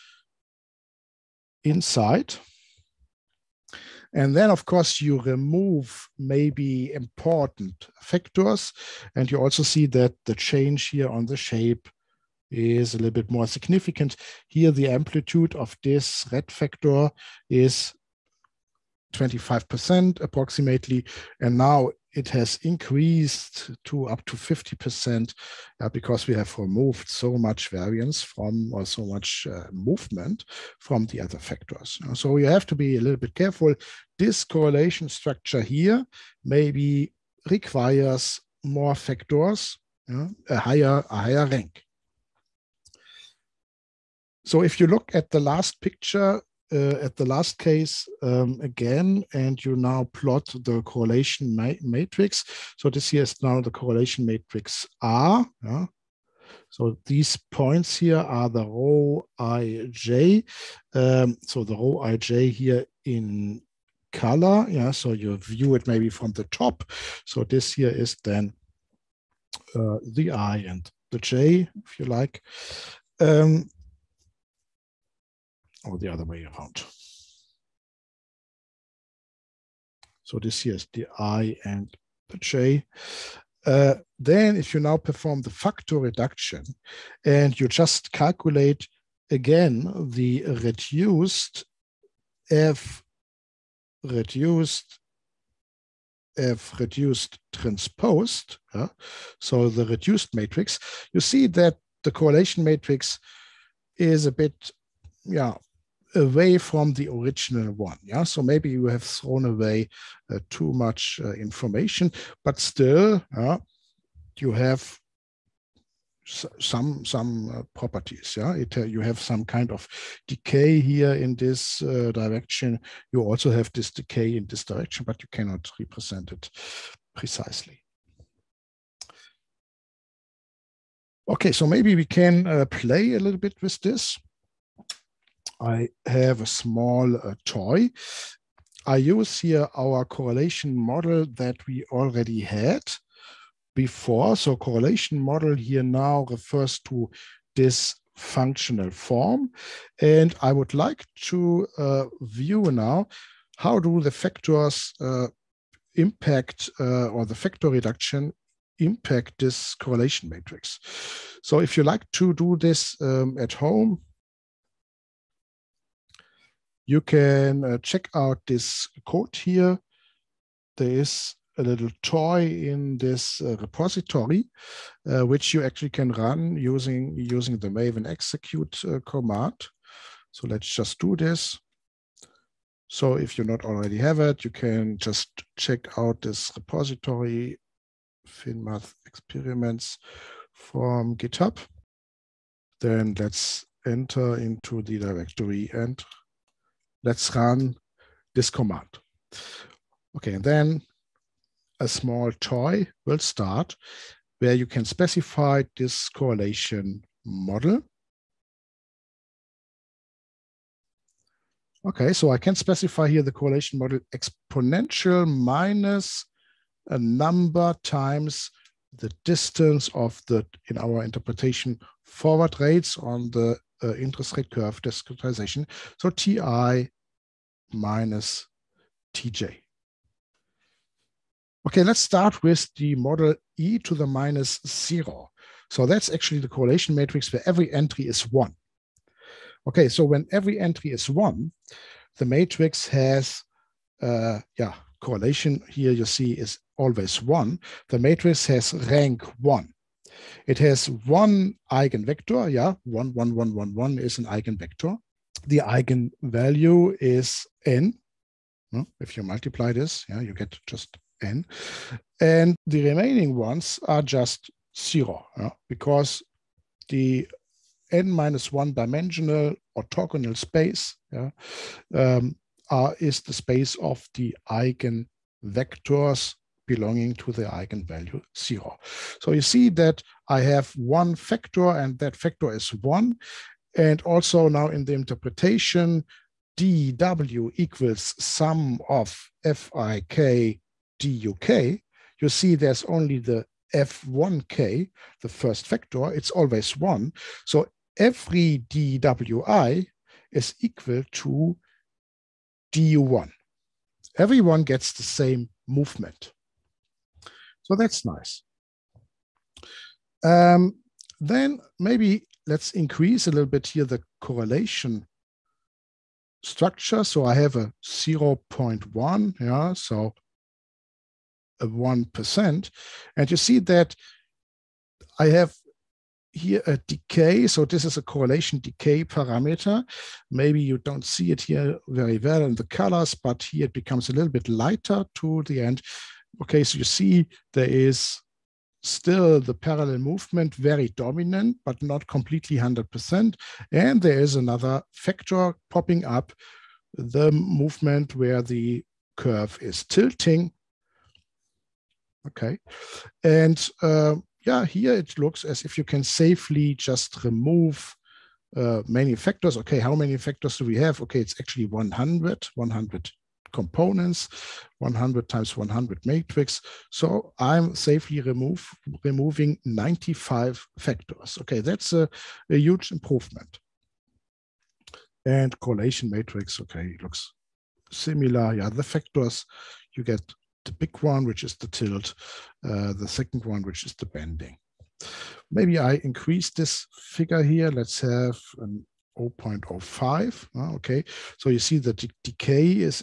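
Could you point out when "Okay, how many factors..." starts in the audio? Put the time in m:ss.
5:59.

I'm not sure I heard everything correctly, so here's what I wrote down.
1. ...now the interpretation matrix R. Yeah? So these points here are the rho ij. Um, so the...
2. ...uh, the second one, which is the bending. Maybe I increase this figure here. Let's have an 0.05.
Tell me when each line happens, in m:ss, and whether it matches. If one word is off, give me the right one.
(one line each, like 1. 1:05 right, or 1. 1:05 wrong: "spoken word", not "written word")
1. 0:53 wrong: "correlation", not "interpretation"
2. 6:22 right.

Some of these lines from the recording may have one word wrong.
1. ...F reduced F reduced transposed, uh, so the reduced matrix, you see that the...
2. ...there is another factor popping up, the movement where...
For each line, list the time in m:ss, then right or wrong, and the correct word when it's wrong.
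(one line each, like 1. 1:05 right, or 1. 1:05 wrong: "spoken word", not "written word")
1. 1:32 right
2. 5:44 right.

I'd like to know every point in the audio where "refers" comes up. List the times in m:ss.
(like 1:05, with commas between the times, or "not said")
2:26.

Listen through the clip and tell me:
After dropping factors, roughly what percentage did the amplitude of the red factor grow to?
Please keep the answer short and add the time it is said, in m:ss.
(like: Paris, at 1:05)
50%, at 0:24.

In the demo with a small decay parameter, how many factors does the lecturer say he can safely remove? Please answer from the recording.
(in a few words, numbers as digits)
95.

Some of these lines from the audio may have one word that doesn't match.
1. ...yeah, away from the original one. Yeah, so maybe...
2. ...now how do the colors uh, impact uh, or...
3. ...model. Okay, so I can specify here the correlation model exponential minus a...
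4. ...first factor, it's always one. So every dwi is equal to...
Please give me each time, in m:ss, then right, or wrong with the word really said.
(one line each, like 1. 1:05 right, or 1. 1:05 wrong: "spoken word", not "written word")
1. 1:45 right
2. 2:32 wrong: "factors", not "colors"
3. 3:27 right
4. 4:55 right.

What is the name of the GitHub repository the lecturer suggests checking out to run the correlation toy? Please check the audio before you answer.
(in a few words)
FinMath experiments.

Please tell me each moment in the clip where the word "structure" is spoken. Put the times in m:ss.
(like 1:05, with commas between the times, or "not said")
0:35, 5:16.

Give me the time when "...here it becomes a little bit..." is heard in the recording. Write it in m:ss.
5:33.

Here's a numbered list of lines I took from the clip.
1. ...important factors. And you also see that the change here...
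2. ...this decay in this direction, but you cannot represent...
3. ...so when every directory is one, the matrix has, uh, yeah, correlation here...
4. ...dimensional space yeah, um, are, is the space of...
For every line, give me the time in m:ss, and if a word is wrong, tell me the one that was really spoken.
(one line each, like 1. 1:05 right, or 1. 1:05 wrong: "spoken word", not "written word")
1. 0:06 right
2. 2:03 right
3. 3:59 wrong: "entry", not "directory"
4. 4:29 wrong: "orthogonal", not "dimensional".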